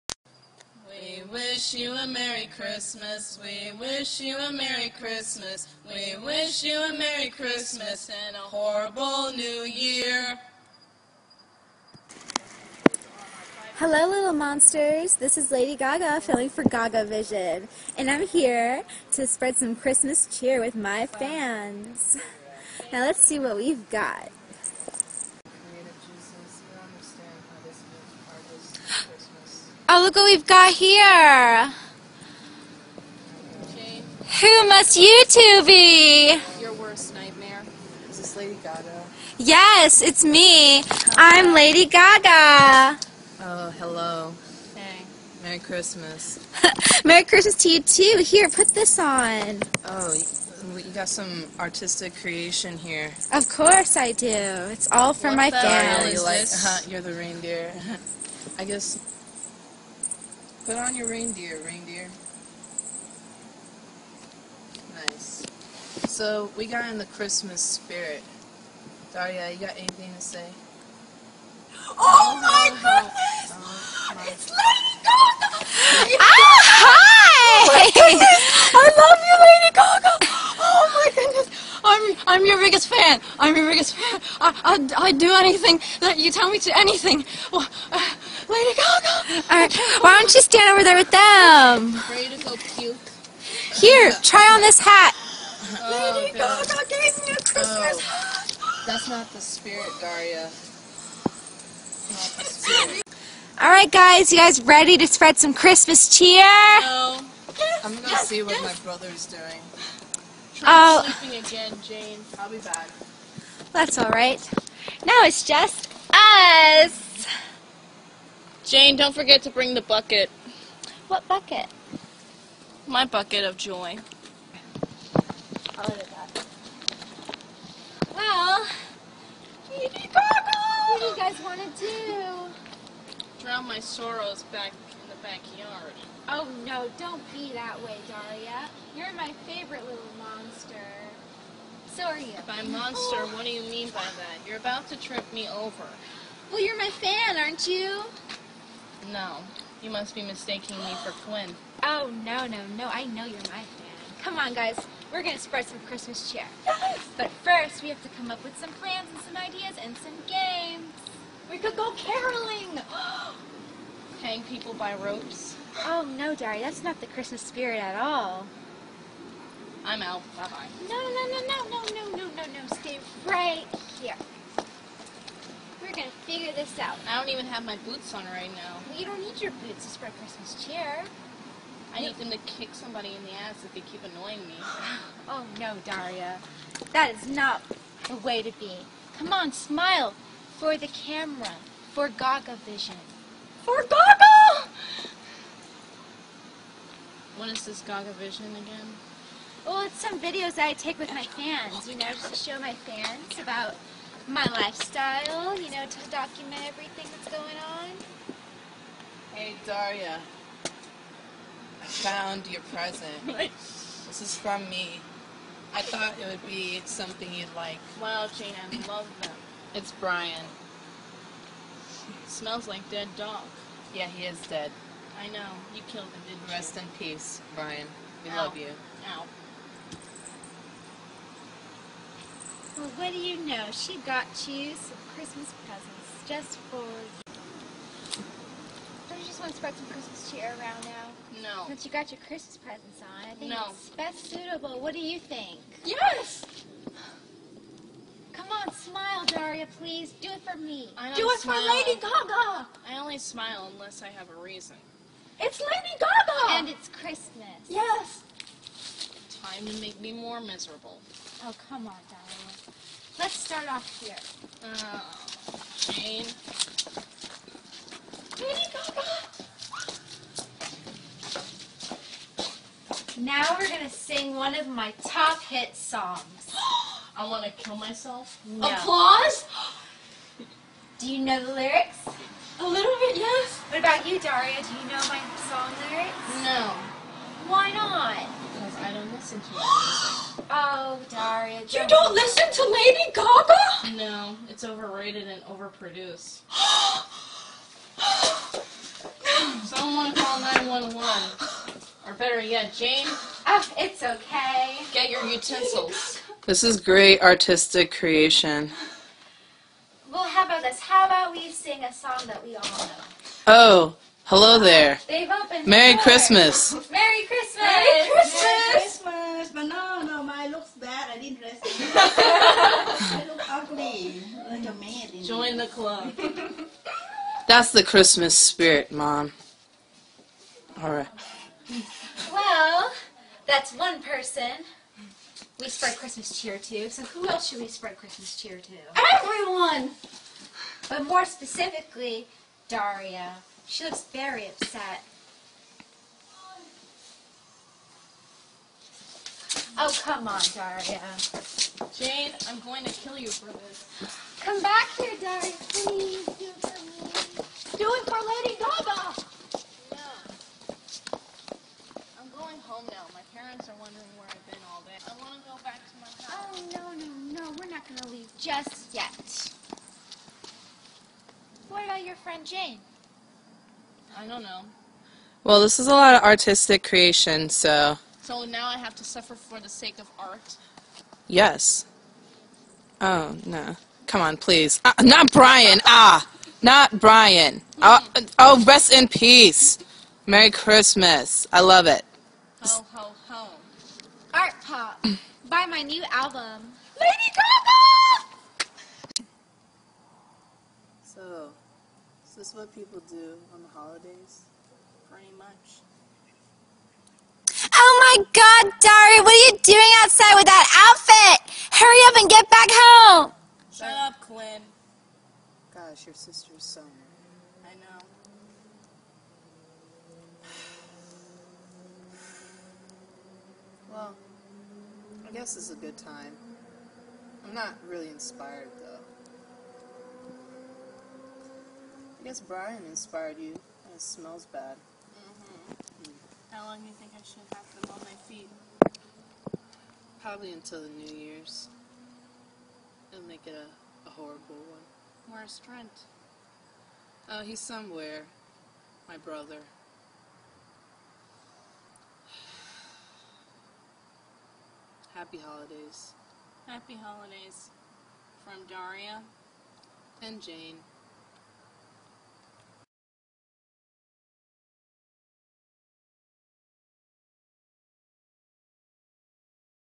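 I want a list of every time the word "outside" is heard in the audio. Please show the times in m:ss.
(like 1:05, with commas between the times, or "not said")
6:50.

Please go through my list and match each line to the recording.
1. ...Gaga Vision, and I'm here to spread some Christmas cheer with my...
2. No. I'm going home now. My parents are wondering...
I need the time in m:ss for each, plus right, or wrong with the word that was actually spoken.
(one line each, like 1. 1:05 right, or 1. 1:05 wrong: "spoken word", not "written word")
1. 0:16 right
2. 5:59 right.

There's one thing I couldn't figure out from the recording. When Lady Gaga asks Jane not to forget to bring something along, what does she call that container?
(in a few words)
bucket of joy.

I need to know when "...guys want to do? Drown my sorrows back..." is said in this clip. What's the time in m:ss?
2:11.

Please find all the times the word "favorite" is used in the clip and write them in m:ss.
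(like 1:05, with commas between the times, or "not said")
2:19.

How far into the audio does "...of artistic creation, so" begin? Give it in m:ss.
6:16.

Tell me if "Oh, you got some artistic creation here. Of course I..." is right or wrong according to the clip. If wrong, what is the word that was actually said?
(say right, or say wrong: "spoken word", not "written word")
right.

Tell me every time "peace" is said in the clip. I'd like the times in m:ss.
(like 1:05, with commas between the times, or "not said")
3:47, 6:29.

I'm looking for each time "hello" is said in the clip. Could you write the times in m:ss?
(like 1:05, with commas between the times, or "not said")
0:13, 0:43, 5:14.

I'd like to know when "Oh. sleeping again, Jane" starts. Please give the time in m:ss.
1:50.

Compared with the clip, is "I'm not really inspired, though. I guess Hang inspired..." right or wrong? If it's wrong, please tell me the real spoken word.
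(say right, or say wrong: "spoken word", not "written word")
wrong: "Brian", not "Hang".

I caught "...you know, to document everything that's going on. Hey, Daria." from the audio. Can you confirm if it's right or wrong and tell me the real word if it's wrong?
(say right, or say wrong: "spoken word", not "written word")
right.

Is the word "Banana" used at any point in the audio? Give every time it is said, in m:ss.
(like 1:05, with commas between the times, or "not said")
5:19.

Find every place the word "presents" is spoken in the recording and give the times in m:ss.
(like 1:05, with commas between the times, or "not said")
3:32, 3:55, 4:02.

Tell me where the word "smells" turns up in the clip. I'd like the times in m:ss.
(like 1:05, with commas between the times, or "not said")
3:42, 7:14.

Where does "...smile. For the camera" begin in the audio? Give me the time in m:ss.
3:09.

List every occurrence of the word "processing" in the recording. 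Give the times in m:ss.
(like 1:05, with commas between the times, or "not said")
not said.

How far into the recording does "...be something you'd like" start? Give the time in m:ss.
3:36.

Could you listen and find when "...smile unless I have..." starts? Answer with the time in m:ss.
4:13.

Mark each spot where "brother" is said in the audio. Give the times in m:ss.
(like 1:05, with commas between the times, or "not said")
1:48, 7:29.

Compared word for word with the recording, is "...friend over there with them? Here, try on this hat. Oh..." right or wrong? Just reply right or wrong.
wrong.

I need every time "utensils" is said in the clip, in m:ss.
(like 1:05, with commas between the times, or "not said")
5:05.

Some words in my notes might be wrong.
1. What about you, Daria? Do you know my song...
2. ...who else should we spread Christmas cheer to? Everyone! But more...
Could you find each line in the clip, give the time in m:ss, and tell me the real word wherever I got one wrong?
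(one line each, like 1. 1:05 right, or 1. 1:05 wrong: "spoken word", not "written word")
1. 4:43 right
2. 5:37 right.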